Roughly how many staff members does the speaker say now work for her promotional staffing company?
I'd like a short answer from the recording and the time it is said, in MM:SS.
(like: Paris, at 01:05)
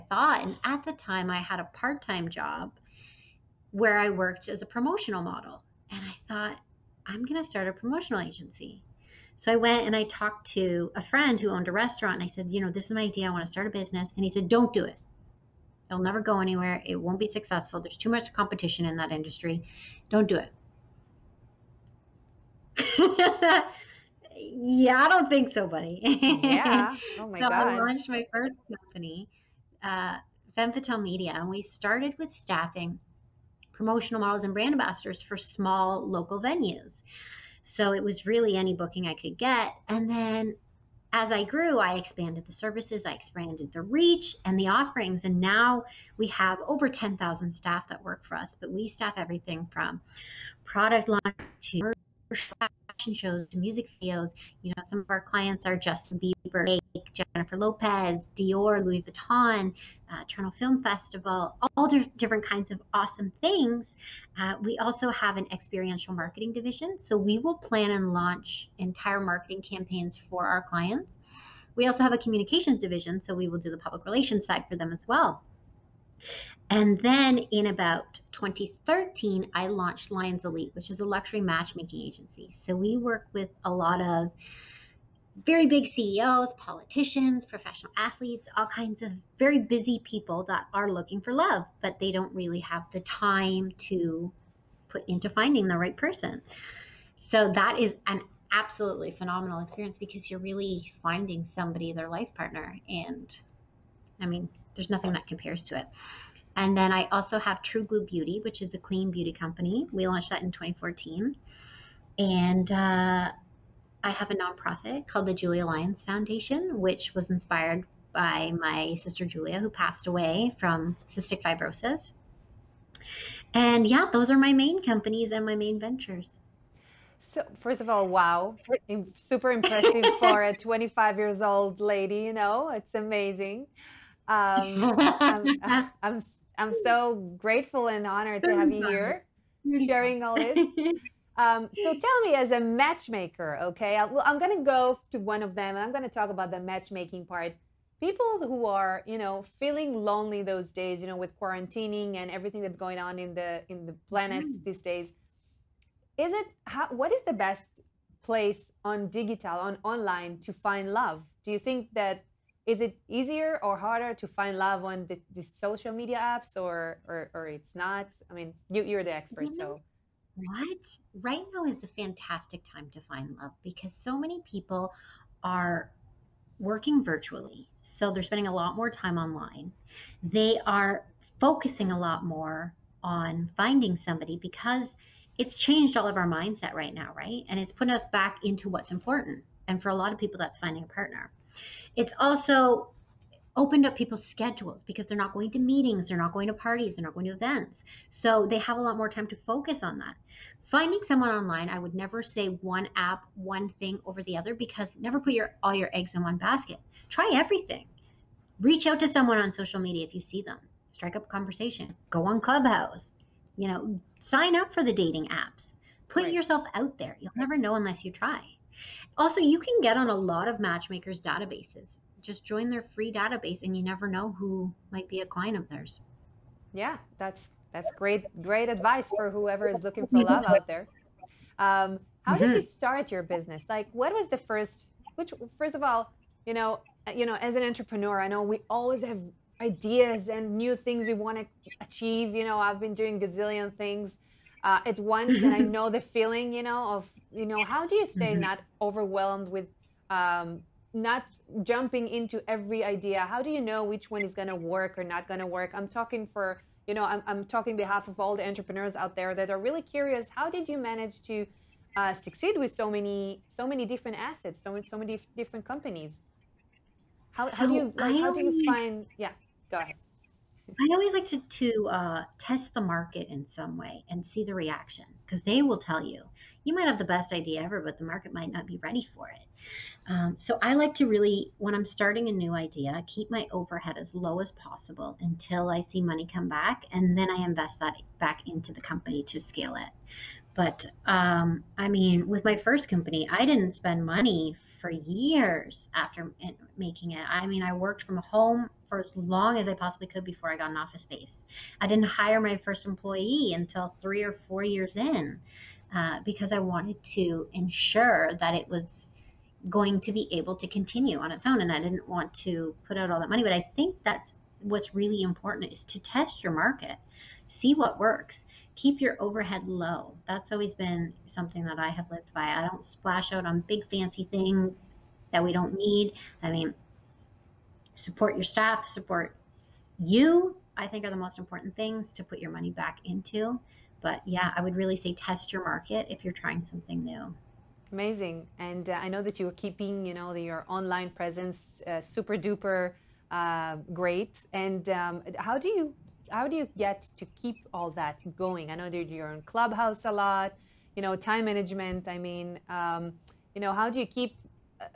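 10,000, at 00:46.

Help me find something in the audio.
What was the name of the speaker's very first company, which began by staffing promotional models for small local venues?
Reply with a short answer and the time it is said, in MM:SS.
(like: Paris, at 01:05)
Femme Fatale Media, at 00:30.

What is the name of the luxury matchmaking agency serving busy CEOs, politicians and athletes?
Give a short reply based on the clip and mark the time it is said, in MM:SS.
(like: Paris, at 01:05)
Lyons Elite, at 01:20.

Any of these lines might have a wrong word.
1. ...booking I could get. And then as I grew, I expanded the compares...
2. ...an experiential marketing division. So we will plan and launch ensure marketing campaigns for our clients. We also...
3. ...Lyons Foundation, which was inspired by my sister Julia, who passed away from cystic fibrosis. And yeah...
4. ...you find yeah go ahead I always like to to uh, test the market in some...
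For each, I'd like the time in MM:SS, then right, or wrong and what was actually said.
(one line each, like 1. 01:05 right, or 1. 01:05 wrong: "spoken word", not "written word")
1. 00:38 wrong: "services", not "compares"
2. 01:05 wrong: "entire", not "ensure"
3. 01:55 right
4. 04:28 right.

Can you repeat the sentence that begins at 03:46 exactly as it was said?
Yeah, that's that's great great advice for whoever is looking for love out there.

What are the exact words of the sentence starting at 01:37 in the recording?
So that is an absolutely phenomenal experience because you're really finding somebody, their life partner.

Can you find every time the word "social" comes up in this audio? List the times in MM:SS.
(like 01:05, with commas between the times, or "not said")
02:45, 03:29.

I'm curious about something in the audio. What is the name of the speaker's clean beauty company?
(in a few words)
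True Glue Beauty.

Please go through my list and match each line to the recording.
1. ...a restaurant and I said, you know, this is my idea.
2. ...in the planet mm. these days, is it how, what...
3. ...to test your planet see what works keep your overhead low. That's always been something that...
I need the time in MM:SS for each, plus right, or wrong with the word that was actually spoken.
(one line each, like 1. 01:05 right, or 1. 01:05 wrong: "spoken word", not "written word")
1. 00:11 right
2. 02:33 right
3. 05:15 wrong: "market", not "planet".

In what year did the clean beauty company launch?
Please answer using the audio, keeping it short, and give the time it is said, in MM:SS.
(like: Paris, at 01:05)
2014, at 01:50.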